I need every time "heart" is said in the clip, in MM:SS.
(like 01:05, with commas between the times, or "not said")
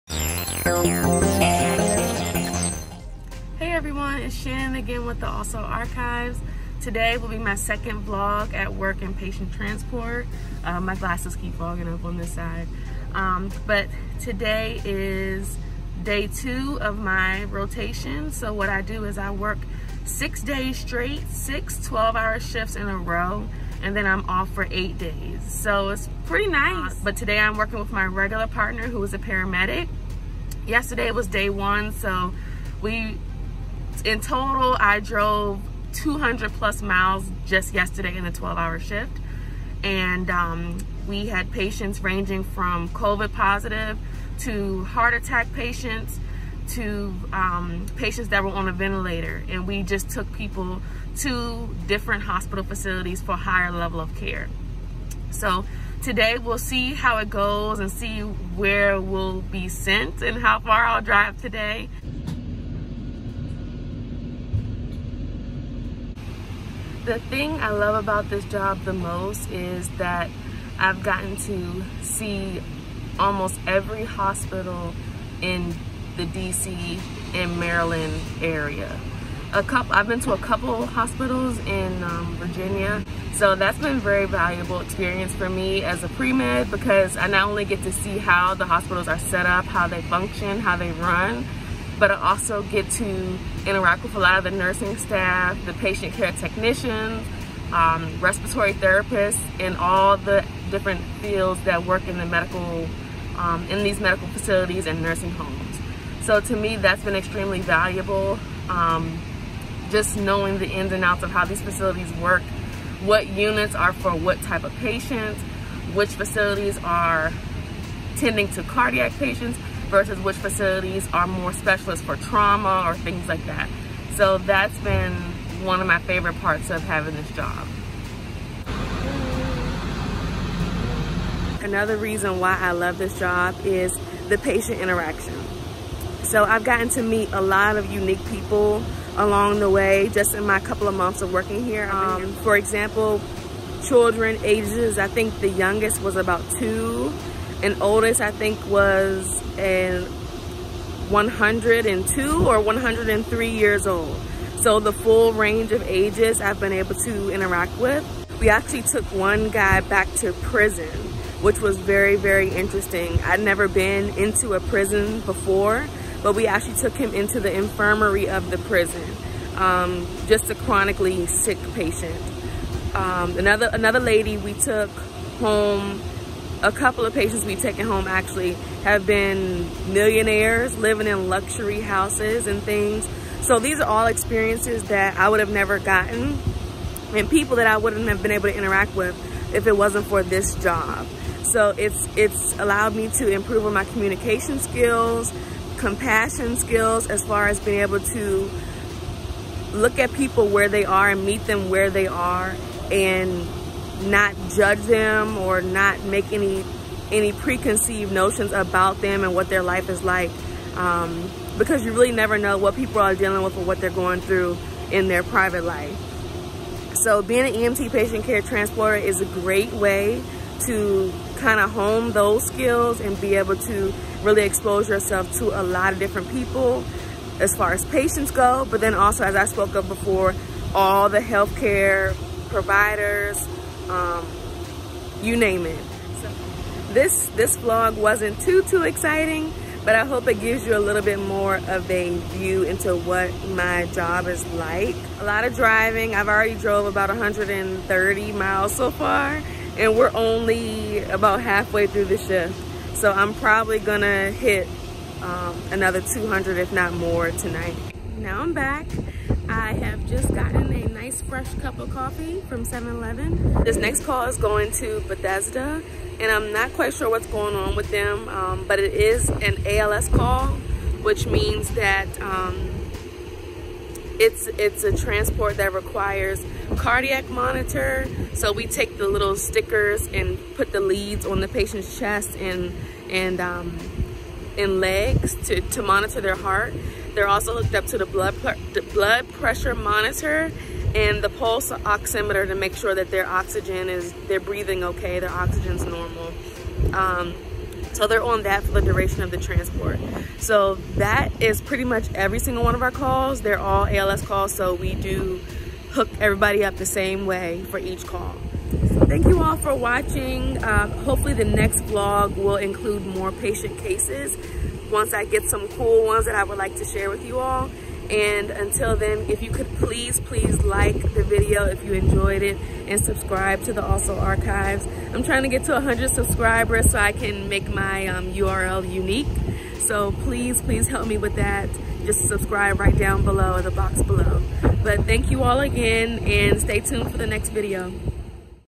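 00:44, 04:46.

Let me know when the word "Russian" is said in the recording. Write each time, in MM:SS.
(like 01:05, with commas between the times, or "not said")
not said.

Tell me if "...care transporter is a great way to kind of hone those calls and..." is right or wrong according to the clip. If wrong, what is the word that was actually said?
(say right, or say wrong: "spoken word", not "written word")
wrong: "skills", not "calls".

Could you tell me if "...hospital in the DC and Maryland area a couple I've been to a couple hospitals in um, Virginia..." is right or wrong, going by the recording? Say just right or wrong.
right.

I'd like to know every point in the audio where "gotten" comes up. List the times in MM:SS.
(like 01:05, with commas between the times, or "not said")
01:11, 02:16, 03:05, 04:20.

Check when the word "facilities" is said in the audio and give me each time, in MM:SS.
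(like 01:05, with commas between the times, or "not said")
00:52, 01:44, 01:51, 01:56, 02:00.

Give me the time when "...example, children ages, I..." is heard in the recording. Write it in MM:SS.
02:22.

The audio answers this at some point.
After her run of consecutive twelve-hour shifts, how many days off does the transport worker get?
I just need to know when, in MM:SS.
00:24.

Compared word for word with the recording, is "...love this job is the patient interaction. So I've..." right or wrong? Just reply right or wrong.
right.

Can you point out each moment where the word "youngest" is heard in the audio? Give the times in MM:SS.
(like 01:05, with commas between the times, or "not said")
02:25.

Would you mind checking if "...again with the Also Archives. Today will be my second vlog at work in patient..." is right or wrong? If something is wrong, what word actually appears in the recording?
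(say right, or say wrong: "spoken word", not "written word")
right.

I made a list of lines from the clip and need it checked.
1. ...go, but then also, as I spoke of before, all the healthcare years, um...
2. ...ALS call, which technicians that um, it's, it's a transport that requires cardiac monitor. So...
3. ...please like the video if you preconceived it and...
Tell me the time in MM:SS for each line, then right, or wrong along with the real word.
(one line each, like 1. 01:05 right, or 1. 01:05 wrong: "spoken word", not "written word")
1. 03:48 wrong: "providers", not "years"
2. 04:29 wrong: "means", not "technicians"
3. 05:20 wrong: "enjoyed", not "preconceived".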